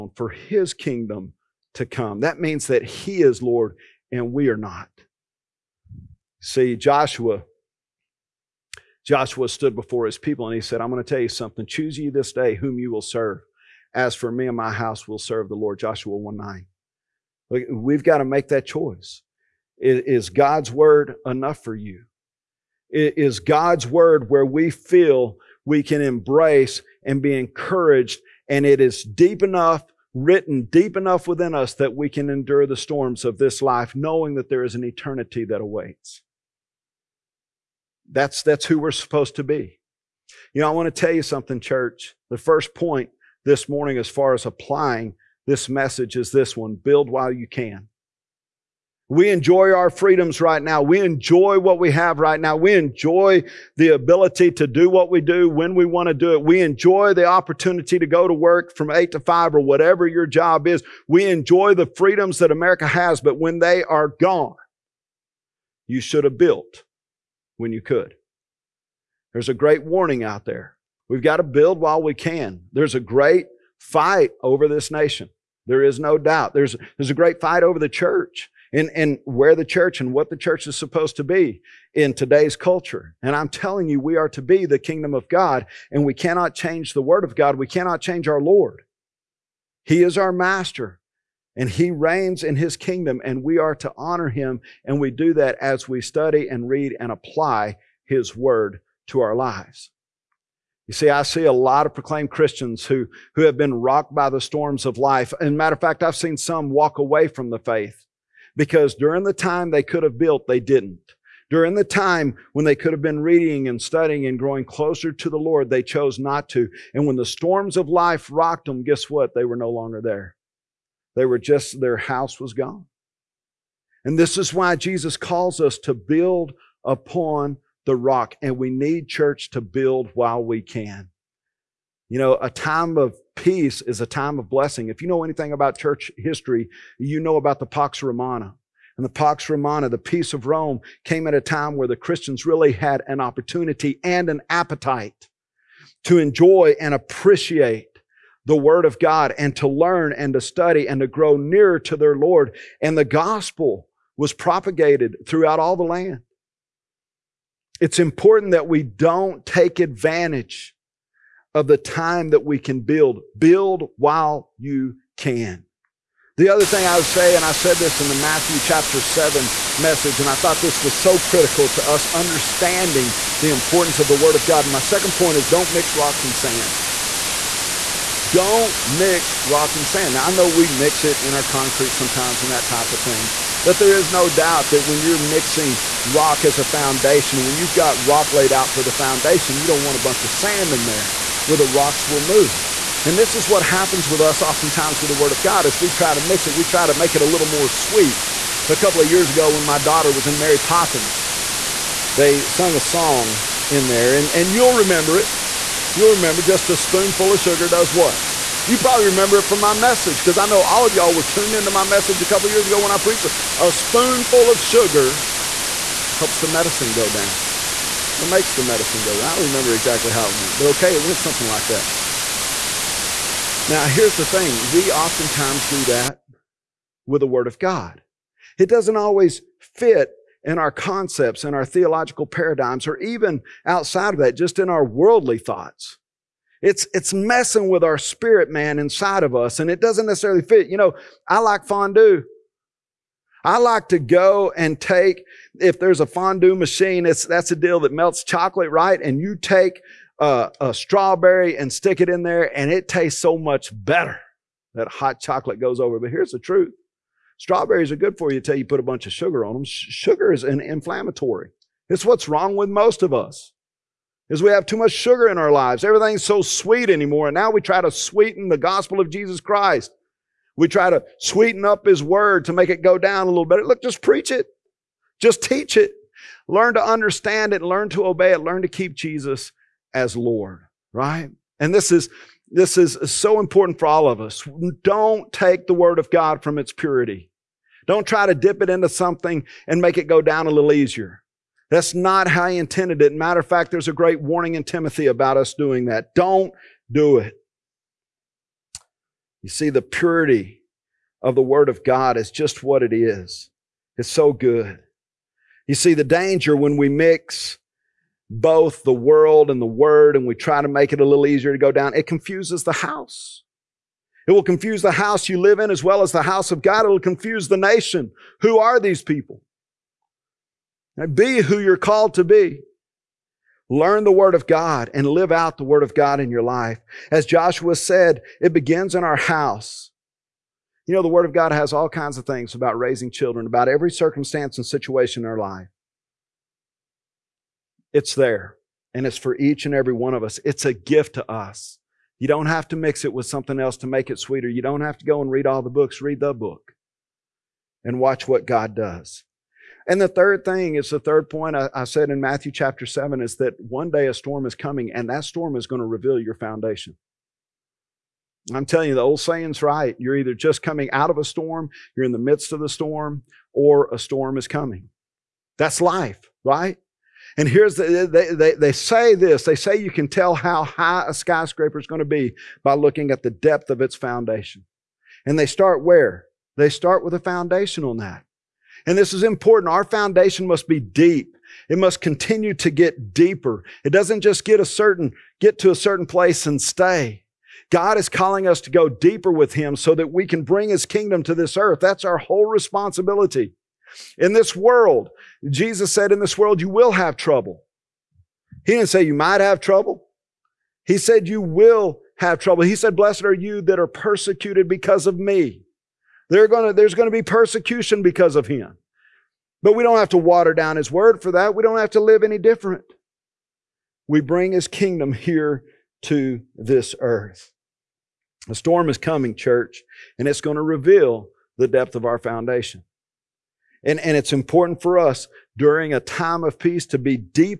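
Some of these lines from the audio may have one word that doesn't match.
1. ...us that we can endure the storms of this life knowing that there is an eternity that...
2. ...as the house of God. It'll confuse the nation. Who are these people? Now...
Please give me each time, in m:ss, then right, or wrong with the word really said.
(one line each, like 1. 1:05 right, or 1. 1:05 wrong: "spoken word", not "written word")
1. 0:31 right
2. 5:16 right.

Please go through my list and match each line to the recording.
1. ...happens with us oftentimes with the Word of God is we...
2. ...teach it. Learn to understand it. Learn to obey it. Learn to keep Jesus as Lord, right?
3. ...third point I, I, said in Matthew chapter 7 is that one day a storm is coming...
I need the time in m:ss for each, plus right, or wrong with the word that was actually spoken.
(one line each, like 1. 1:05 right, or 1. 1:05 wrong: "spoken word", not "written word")
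1. 3:13 right
2. 4:35 right
3. 5:50 right.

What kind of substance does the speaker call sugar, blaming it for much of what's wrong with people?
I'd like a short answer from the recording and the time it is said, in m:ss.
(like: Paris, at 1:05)
An inflammatory, at 4:20.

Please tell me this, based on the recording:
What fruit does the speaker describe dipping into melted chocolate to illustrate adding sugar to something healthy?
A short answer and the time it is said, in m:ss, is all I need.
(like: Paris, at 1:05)
Strawberry, at 4:10.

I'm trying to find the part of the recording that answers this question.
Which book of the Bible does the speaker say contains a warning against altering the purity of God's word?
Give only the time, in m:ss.
4:54.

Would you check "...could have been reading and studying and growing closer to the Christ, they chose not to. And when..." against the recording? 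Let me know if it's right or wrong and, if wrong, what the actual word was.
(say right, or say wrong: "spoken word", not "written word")
wrong: "Lord", not "Christ".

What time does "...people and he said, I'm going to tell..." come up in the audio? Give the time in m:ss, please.
0:10.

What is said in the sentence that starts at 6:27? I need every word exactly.
God is calling us to go deeper with Him so that we can bring His kingdom to this earth.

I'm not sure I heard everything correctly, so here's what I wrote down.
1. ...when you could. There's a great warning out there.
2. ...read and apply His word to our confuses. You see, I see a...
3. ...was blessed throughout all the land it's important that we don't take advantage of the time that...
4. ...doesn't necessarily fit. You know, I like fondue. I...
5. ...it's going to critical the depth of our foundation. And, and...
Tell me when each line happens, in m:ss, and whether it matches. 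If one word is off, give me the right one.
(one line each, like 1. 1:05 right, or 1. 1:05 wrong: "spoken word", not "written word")
1. 1:07 right
2. 1:36 wrong: "lives", not "confuses"
3. 2:34 wrong: "propagated", not "blessed"
4. 3:59 right
5. 7:00 wrong: "reveal", not "critical".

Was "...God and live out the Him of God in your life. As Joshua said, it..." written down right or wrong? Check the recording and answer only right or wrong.
wrong.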